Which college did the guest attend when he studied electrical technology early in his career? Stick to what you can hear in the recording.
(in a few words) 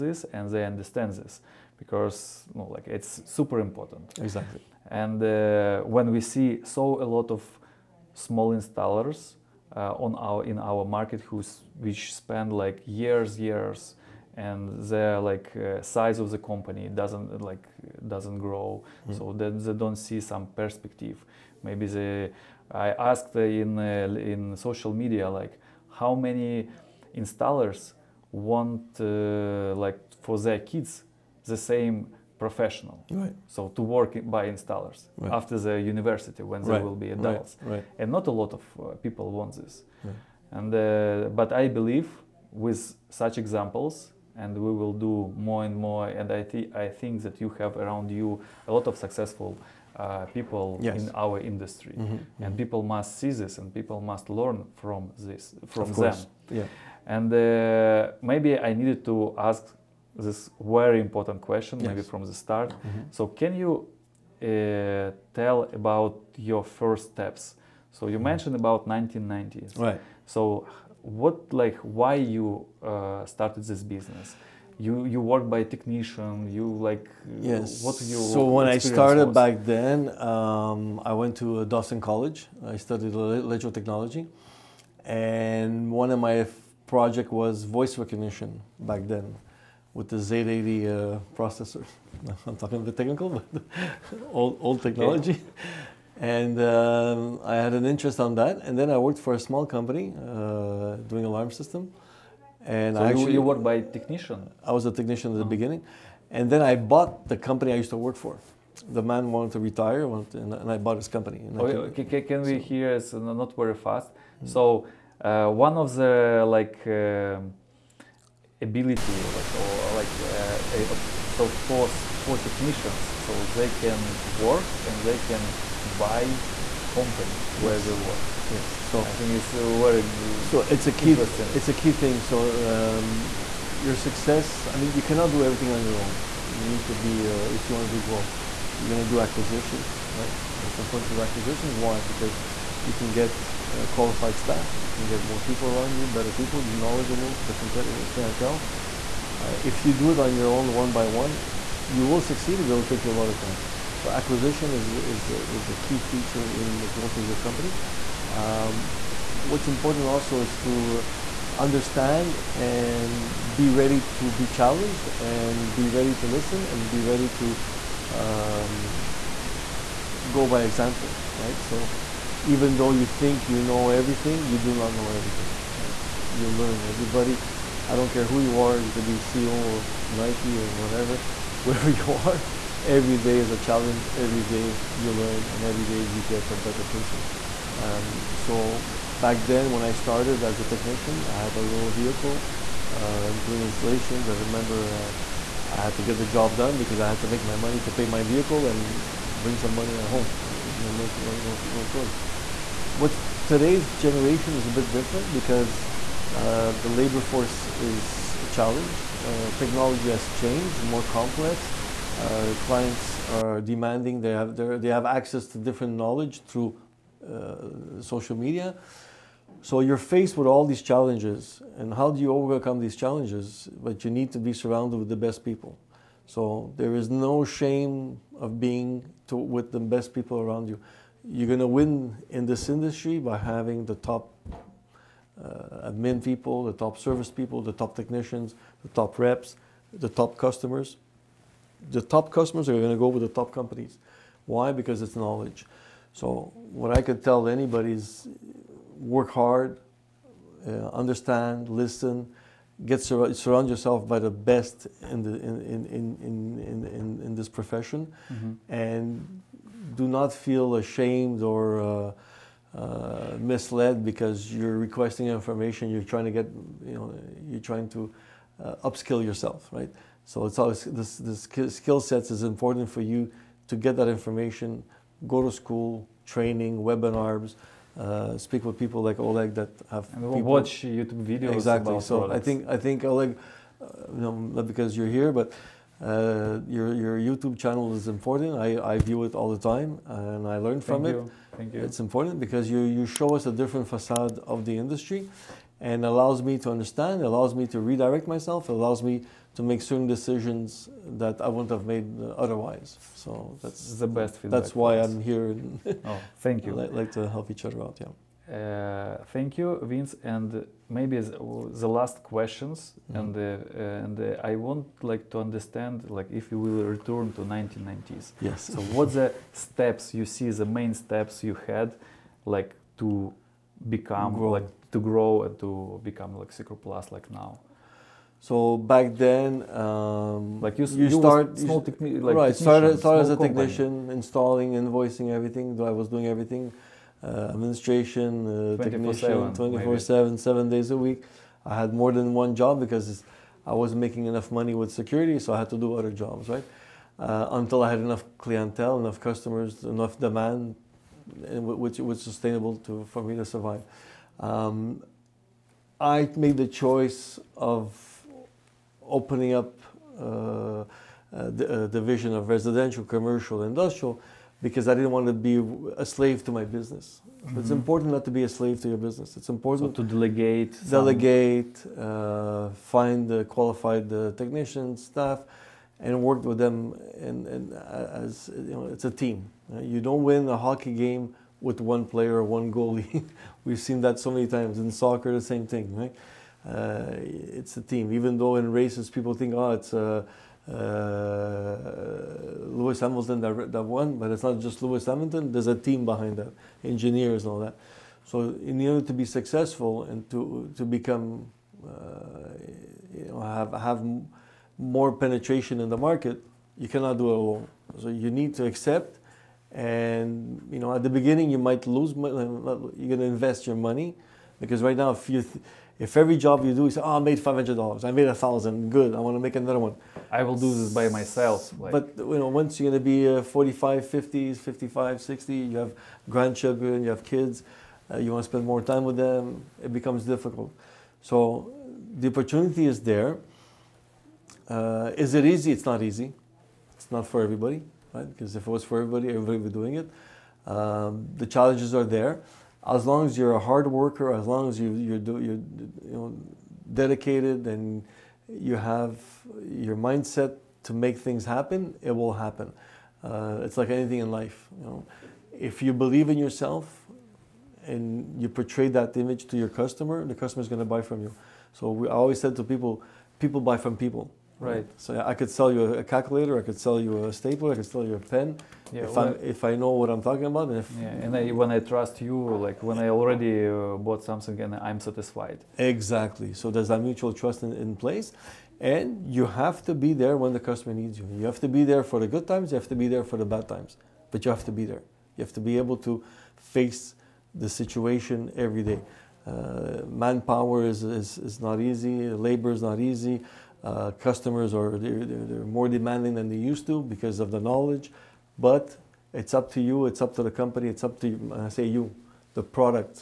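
Dawson College.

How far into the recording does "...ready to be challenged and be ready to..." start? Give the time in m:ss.
2:43.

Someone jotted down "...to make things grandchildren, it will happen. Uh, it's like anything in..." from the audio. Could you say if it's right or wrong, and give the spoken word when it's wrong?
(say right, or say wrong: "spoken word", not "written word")
wrong: "happen", not "grandchildren".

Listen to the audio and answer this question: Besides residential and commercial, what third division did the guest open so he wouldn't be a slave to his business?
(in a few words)
industrial.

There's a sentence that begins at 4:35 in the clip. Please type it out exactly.
Go to school, training, webinars uh, speak with people like Oleg that have and people.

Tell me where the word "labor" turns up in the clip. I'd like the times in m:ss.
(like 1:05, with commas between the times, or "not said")
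3:26, 8:12.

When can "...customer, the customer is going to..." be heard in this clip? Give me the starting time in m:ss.
7:39.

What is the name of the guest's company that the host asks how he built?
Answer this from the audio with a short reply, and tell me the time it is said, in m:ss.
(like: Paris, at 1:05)
SecurPlus, at 5:26.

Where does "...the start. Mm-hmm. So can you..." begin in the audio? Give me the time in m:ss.
1:02.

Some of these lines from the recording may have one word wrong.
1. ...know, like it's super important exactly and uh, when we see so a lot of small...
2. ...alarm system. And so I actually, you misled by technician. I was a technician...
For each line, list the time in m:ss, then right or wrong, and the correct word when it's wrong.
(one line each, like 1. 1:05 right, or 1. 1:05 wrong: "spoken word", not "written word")
1. 0:02 right
2. 1:41 wrong: "worked", not "misled".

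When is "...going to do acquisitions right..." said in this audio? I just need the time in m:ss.
2:18.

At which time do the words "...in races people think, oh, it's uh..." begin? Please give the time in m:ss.
6:28.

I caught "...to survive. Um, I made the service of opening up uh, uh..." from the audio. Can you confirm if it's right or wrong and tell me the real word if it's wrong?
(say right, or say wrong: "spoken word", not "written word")
wrong: "choice", not "service".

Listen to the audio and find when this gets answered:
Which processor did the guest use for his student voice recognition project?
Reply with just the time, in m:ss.
1:30.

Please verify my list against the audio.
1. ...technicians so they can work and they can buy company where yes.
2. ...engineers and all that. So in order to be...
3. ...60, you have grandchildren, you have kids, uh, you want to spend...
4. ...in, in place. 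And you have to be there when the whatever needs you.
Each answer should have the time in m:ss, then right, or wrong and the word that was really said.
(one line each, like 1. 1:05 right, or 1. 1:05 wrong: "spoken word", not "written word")
1. 2:02 right
2. 6:36 right
3. 7:05 right
4. 7:57 wrong: "customer", not "whatever".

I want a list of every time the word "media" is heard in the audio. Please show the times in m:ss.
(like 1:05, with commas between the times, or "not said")
0:24, 3:38.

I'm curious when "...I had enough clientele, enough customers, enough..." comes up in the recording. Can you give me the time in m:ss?
5:47.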